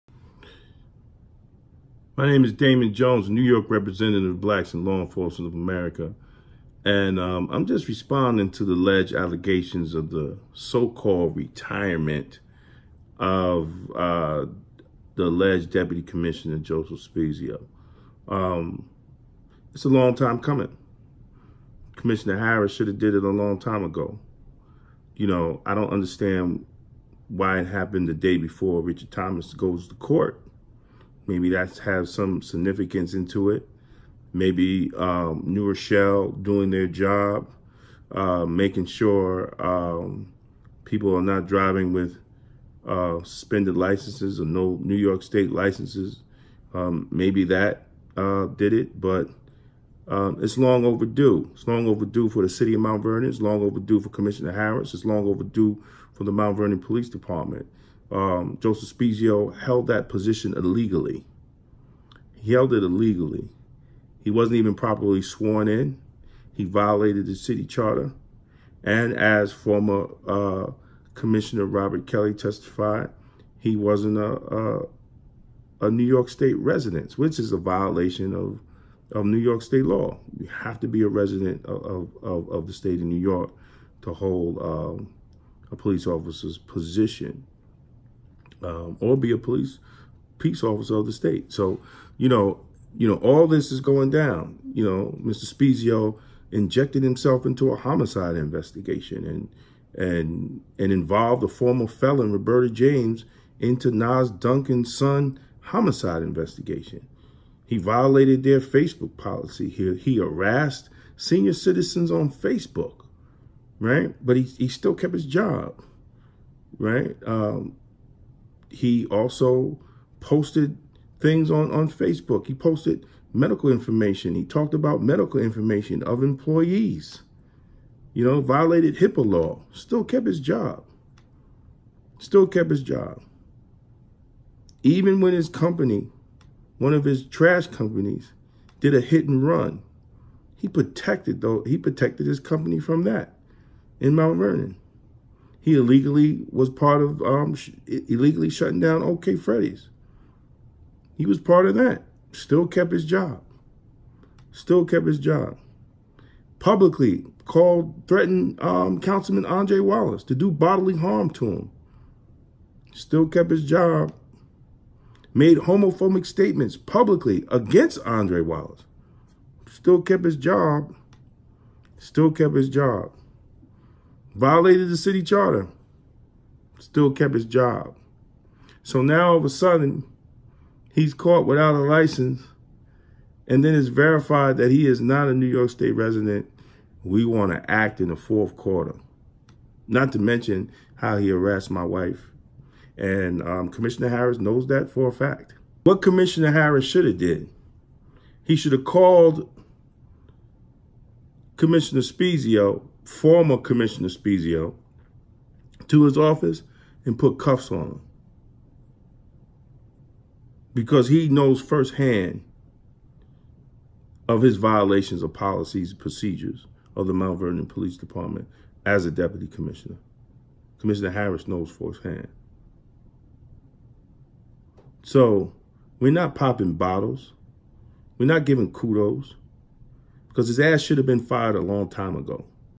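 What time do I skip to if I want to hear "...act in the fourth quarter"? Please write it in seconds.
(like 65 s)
187 s.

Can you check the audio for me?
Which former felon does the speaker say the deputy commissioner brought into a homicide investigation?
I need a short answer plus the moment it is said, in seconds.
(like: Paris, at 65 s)
Roberta James, at 102 s.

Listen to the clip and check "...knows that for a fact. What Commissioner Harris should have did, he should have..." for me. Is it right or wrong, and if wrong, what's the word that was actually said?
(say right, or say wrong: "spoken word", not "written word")
right.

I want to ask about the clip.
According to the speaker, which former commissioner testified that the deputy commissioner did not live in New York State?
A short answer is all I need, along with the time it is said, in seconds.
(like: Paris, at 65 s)
Robert Kelly, at 71 s.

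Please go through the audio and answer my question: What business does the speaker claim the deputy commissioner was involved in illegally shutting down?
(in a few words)
OK Freddy's.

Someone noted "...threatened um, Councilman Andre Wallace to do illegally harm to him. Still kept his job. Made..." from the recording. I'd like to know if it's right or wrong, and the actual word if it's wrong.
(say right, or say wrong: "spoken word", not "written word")
wrong: "bodily", not "illegally".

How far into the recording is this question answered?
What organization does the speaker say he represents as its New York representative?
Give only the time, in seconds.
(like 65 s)
4 s.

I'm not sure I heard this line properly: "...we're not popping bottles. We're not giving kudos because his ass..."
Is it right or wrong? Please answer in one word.
right.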